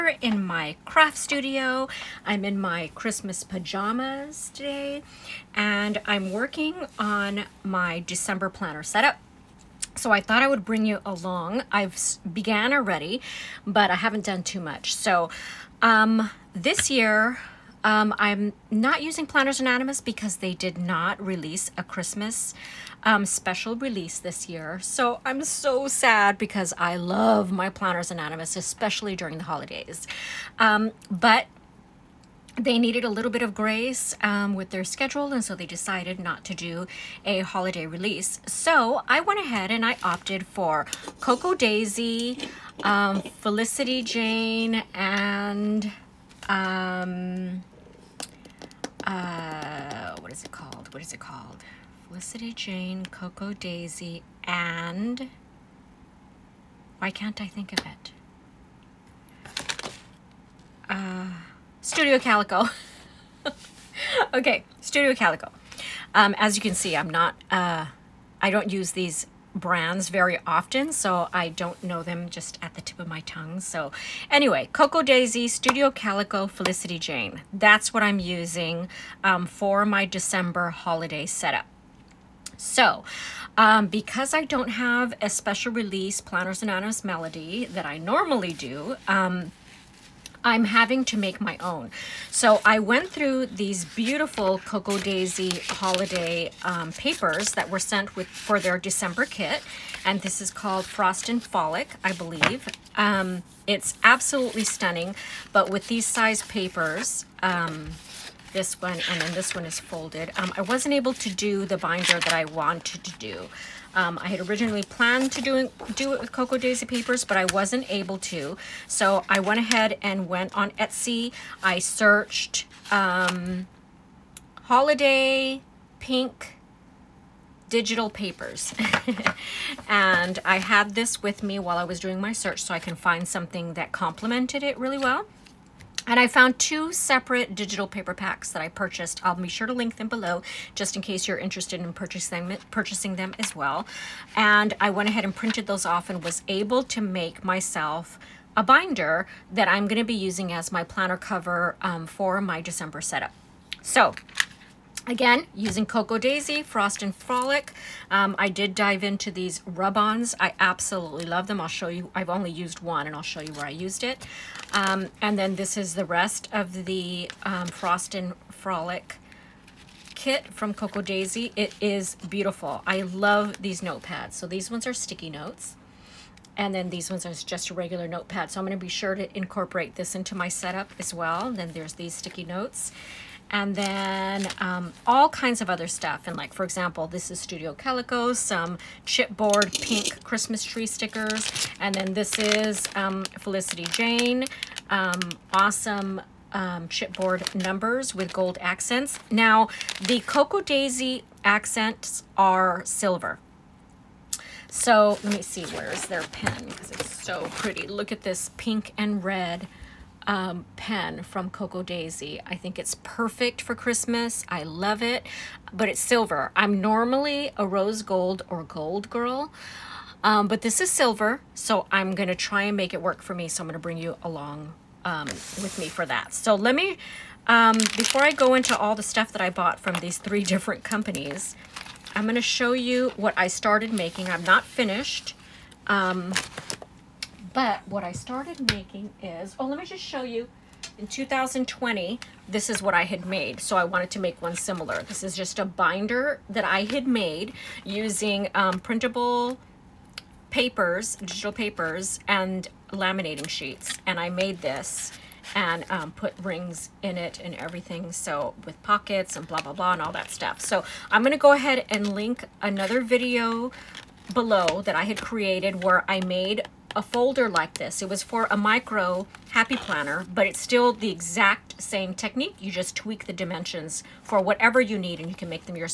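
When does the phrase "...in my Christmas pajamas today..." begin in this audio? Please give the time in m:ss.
0:02.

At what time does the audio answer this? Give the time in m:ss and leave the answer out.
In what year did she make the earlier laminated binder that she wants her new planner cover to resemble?
4:01.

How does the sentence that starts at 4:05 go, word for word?
This is just a binder that I had made using um, printable papers, digital papers, and laminating sheets.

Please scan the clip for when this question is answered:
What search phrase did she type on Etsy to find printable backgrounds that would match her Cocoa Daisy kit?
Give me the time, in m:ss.
2:04.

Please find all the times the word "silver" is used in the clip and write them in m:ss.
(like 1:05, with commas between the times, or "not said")
3:22, 3:35, 3:40.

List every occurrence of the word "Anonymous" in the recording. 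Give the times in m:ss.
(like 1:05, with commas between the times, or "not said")
0:19, 0:28, 1:26.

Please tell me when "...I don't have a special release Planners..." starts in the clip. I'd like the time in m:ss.
1:24.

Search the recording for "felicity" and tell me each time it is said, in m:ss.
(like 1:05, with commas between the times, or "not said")
0:43, 0:52, 1:16, 3:13.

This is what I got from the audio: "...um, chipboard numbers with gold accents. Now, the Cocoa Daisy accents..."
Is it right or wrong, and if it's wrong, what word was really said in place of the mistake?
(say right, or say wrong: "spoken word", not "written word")
right.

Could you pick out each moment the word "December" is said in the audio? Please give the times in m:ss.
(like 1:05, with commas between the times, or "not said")
0:08, 1:20, 1:38, 2:32.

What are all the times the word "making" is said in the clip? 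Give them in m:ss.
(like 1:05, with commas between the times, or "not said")
3:53, 3:58.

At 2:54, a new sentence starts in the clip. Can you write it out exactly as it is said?
So these ones are sticky notes.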